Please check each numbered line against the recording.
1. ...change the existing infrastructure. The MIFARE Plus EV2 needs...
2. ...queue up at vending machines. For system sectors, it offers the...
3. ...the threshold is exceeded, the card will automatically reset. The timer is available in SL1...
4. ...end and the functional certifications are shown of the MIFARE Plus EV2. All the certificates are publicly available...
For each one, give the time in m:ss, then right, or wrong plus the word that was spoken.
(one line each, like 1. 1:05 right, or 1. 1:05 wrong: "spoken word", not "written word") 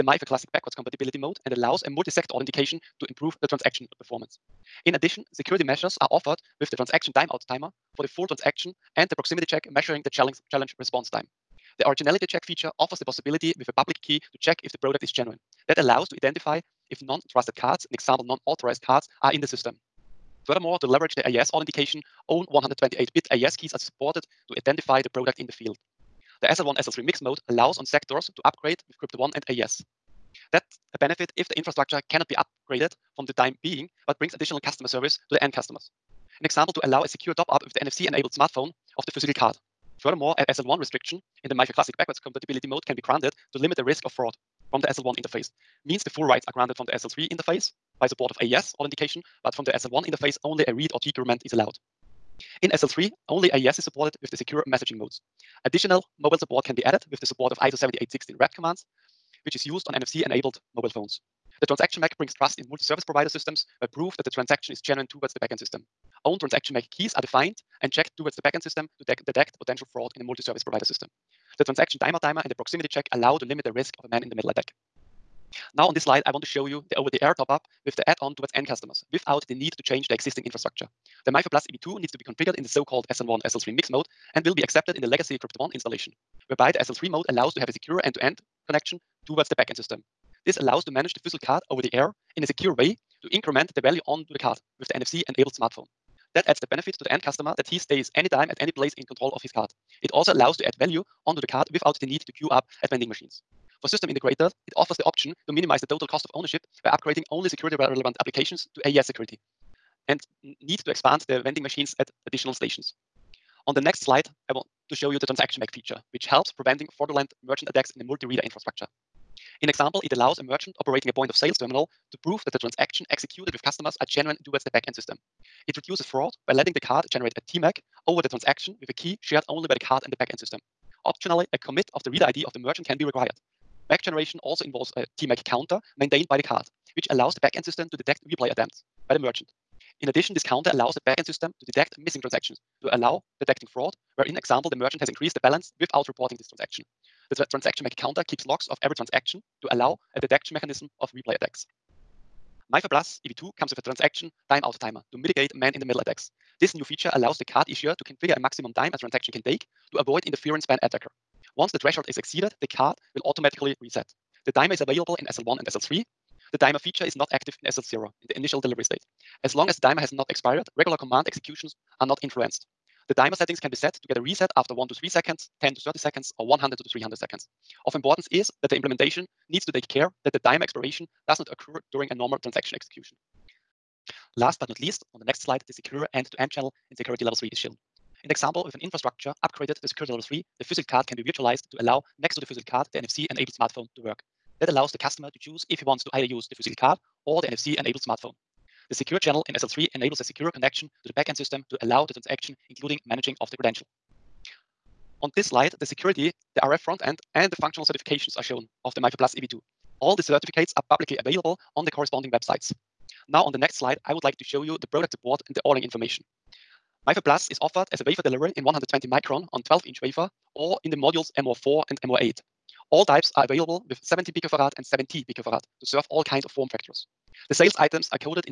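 1. 1:19 right
2. 1:42 wrong: "integrators", not "sectors"
3. 2:41 right
4. 3:27 right.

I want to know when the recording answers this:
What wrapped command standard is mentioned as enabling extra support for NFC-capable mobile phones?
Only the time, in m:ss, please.
0:57.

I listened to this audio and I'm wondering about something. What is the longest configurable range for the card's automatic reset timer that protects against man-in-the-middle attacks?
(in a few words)
100 to 300 seconds.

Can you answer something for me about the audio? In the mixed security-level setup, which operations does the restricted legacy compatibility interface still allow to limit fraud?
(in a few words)
read or decrement.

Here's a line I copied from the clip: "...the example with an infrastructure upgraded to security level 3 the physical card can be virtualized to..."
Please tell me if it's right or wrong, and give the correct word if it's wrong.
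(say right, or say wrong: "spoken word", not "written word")
right.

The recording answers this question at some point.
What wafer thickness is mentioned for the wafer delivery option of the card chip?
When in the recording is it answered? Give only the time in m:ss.
3:38.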